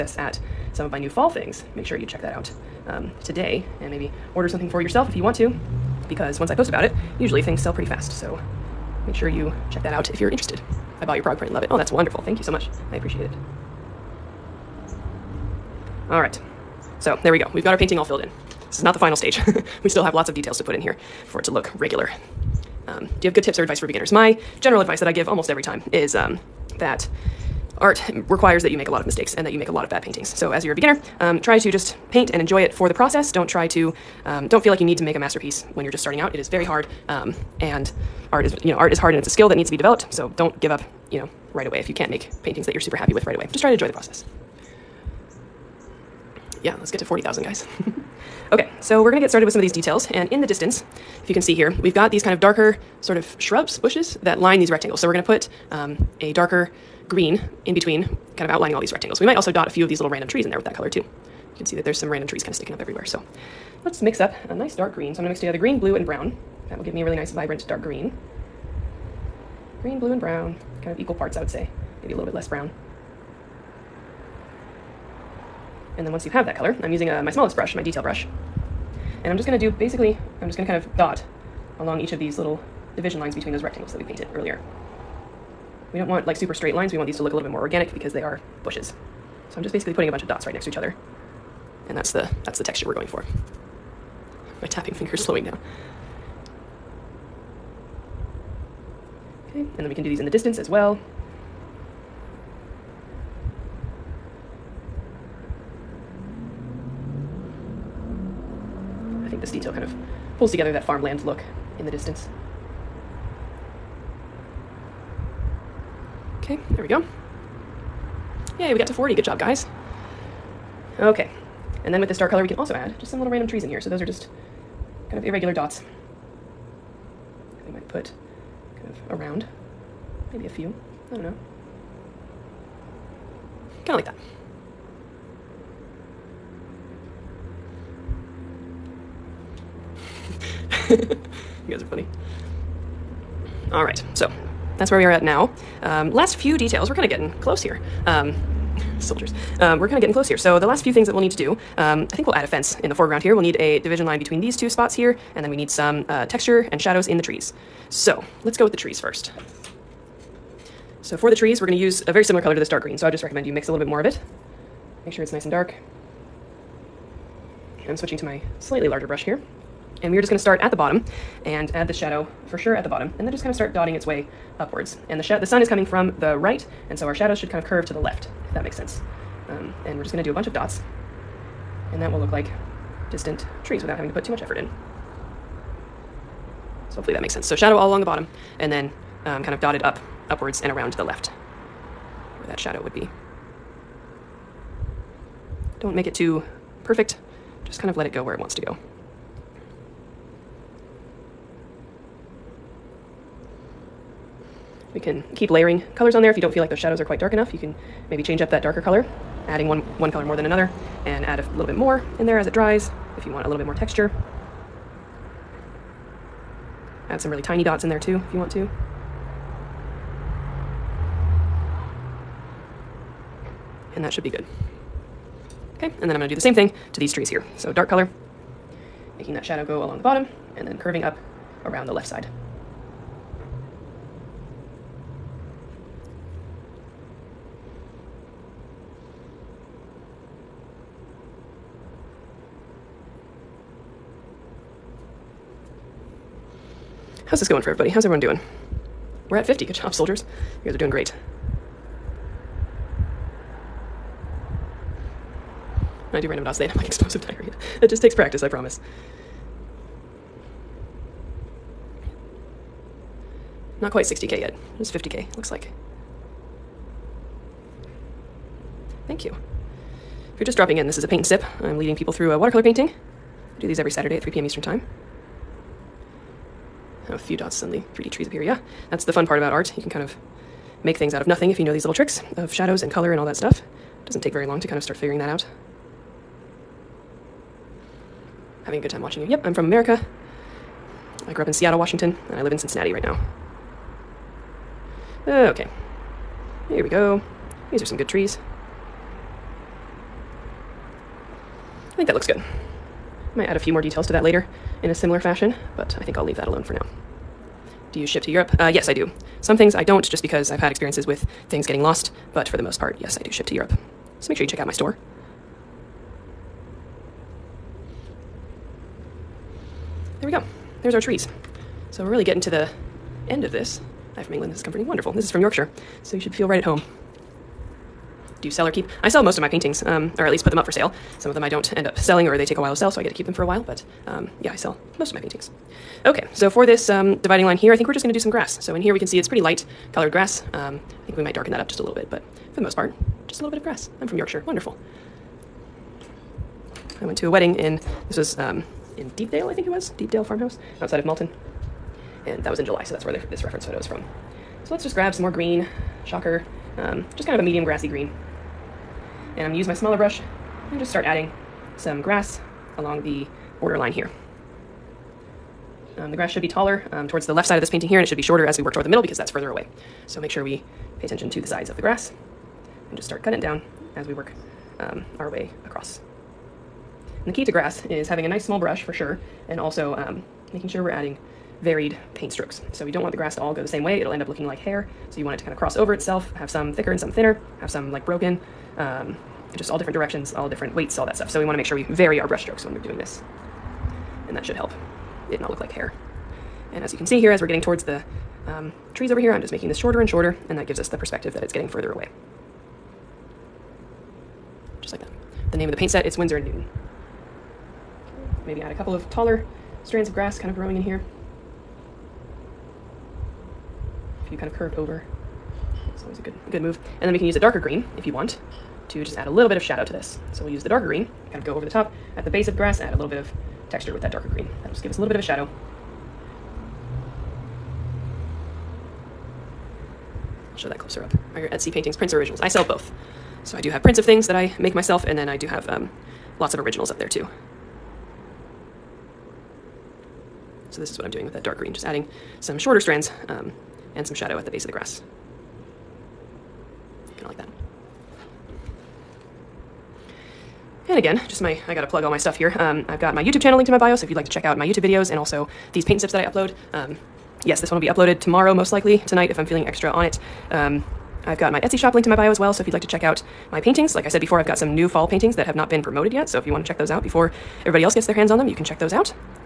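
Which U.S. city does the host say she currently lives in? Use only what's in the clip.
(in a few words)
Cincinnati.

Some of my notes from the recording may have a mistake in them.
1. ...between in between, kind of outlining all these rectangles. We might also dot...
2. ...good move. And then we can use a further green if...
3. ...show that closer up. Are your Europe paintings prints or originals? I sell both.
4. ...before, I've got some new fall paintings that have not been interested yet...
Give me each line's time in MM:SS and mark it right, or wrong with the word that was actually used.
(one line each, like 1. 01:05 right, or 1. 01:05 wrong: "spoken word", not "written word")
1. 00:57 wrong: "green", not "between"
2. 06:56 wrong: "darker", not "further"
3. 07:10 wrong: "Etsy", not "Europe"
4. 07:44 wrong: "promoted", not "interested".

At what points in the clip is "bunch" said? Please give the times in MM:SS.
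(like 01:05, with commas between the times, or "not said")
01:30, 03:00.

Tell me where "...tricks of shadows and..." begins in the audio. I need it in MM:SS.
04:41.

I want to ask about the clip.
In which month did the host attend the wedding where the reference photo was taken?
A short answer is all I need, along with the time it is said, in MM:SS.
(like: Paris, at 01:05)
July, at 05:52.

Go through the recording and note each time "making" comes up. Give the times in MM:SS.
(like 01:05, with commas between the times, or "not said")
03:49, 06:20, 06:39.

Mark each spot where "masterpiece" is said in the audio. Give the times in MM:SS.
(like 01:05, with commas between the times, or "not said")
00:35.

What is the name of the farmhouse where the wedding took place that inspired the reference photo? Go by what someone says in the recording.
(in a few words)
Deepdale Farmhouse.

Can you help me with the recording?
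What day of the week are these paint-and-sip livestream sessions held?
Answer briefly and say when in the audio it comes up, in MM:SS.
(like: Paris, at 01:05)
Saturday, at 04:33.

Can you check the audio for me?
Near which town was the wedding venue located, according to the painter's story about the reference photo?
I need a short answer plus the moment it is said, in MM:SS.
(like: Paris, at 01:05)
Malton, at 05:51.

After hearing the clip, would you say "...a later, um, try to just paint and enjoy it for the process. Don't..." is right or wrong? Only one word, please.
wrong.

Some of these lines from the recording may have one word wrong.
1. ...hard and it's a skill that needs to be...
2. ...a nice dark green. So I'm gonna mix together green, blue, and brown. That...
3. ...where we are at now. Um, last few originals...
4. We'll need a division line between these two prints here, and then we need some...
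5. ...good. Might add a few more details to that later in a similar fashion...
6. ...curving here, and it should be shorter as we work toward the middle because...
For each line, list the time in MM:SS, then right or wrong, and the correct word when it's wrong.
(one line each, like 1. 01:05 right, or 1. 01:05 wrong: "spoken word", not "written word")
1. 00:38 right
2. 01:04 right
3. 02:24 wrong: "details", not "originals"
4. 02:33 wrong: "spots", not "prints"
5. 05:02 right
6. 06:07 wrong: "painting", not "curving".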